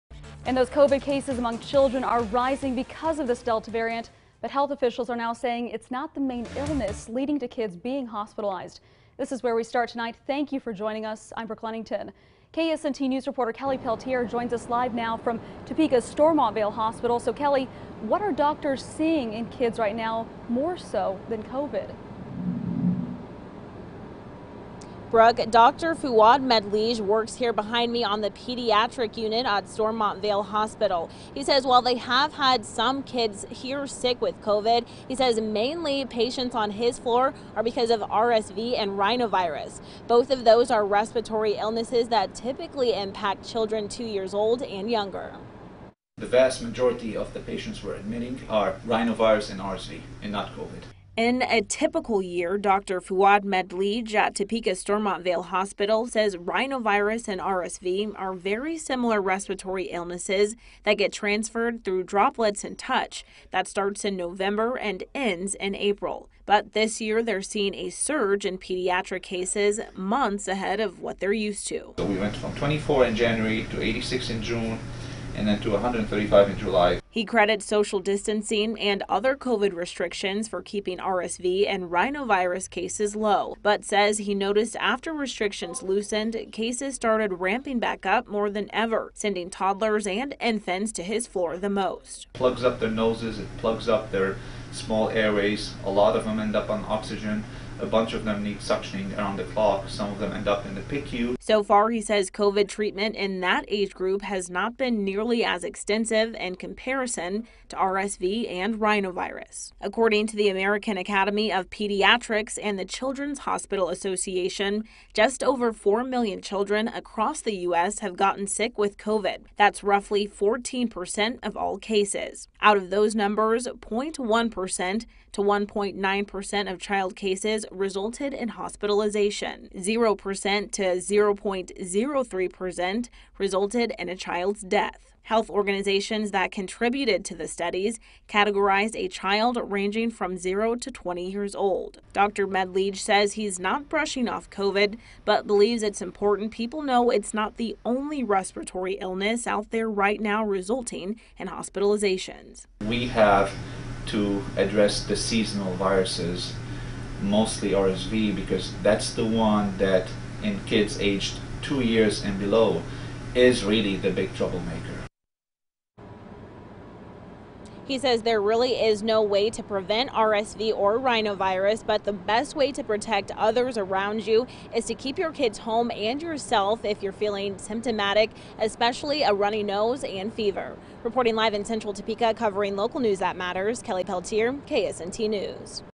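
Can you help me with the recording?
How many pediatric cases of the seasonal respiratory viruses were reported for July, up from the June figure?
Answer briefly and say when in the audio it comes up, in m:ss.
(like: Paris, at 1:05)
135, at 1:15.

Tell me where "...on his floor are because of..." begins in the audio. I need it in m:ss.
0:36.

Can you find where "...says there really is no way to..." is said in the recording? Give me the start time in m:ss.
2:47.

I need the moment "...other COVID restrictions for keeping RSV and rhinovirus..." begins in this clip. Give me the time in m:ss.
1:19.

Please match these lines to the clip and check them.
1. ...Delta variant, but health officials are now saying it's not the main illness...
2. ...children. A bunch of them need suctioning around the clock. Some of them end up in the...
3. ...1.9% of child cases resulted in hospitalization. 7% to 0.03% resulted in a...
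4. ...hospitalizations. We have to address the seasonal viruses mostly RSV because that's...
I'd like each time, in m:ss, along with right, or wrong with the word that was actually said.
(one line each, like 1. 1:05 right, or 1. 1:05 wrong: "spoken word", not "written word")
1. 0:03 right
2. 1:36 wrong: "oxygen", not "children"
3. 2:05 wrong: "0", not "7"
4. 2:31 right.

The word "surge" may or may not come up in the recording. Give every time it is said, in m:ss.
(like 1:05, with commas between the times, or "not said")
1:07.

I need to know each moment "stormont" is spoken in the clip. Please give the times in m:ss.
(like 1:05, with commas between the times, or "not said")
0:16, 0:29, 0:54.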